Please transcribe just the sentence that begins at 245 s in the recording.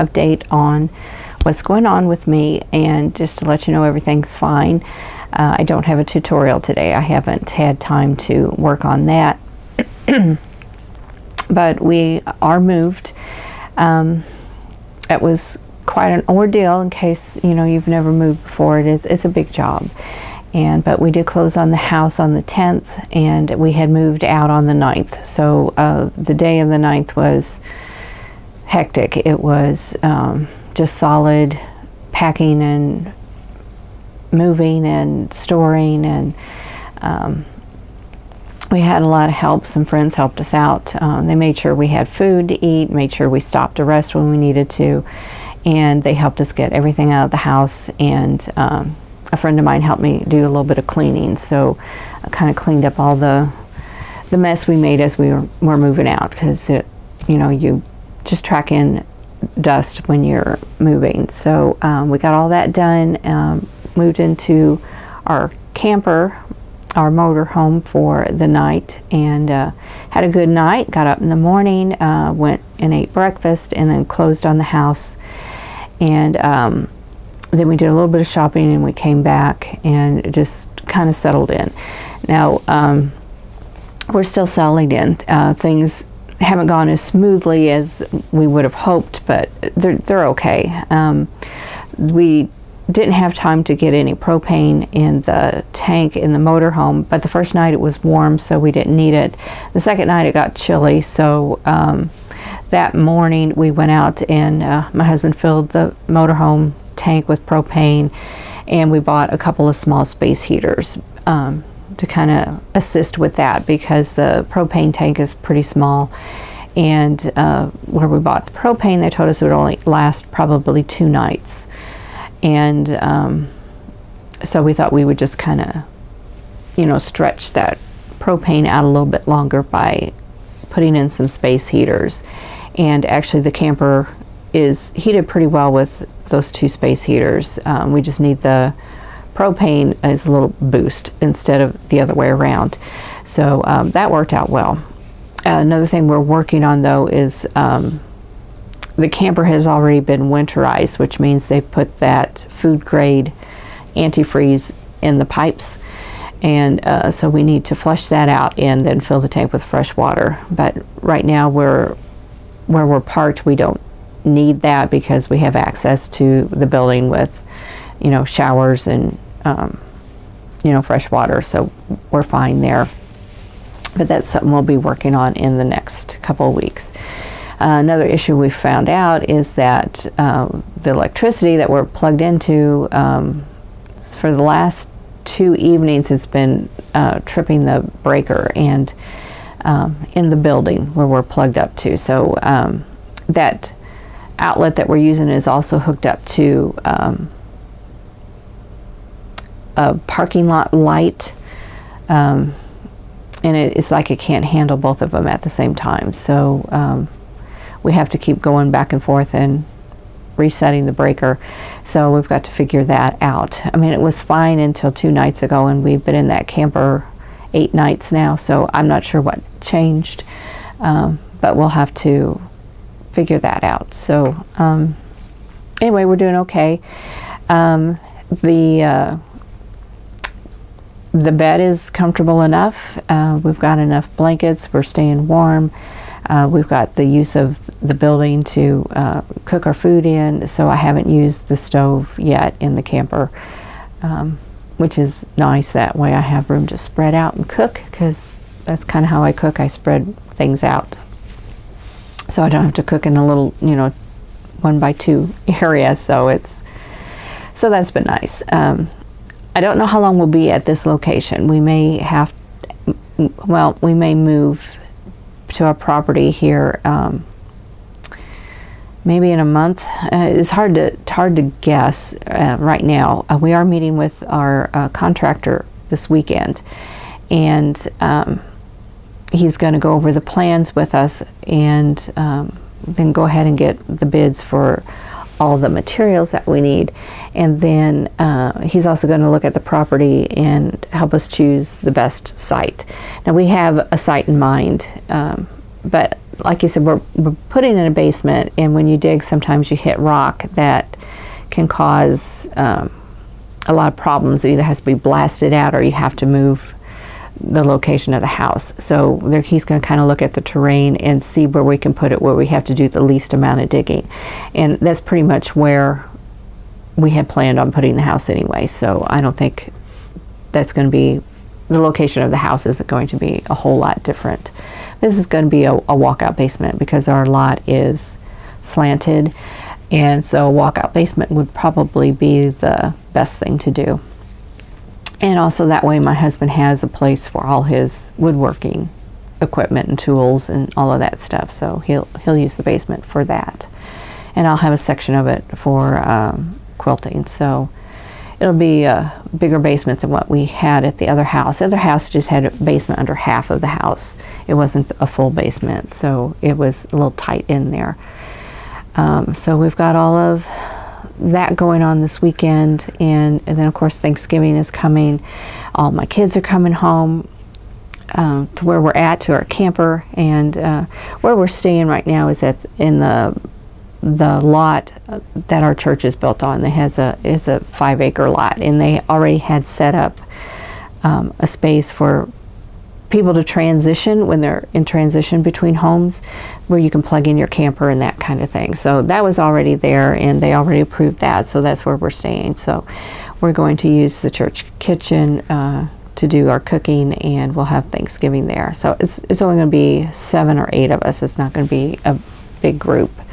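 That way I have room to spread out and cook because that's kind of how I cook.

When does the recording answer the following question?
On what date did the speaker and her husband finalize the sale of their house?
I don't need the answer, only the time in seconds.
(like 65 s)
22 s.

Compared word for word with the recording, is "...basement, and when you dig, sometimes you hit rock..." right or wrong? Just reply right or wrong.
right.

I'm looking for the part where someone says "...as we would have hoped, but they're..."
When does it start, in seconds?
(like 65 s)
87 s.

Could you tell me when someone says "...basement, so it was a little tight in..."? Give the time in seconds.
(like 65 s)
355 s.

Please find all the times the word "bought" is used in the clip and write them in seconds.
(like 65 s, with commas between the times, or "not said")
108 s, 118 s.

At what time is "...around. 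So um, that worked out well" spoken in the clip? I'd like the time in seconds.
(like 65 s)
142 s.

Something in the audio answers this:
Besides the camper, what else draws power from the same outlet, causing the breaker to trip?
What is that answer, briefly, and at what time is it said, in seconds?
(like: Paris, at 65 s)
a parking lot light, at 199 s.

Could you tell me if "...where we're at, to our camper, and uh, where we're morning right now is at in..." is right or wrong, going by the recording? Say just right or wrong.
wrong.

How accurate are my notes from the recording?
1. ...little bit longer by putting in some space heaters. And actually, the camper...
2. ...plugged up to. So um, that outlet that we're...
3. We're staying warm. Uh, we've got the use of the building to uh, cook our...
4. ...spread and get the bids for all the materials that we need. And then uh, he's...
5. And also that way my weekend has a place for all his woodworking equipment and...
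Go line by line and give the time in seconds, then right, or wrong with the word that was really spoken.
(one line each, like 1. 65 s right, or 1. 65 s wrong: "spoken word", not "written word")
1. 128 s right
2. 191 s right
3. 234 s right
4. 283 s wrong: "ahead", not "spread"
5. 335 s wrong: "husband", not "weekend".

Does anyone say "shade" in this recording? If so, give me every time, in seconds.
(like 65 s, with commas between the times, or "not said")
not said.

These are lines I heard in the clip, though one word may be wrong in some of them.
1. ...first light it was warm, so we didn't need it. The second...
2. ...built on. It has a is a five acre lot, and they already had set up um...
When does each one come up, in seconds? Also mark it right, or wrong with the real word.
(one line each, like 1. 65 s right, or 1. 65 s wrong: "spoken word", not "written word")
1. 97 s wrong: "night", not "light"
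2. 376 s right.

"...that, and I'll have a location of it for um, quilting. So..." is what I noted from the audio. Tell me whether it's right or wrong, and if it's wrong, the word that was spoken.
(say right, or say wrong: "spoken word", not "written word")
wrong: "section", not "location".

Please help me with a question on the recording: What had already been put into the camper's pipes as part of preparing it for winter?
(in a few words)
food grade antifreeze.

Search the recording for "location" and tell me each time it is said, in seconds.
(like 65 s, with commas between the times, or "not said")
260 s, 307 s, 321 s.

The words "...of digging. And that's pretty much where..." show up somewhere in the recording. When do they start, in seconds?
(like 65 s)
313 s.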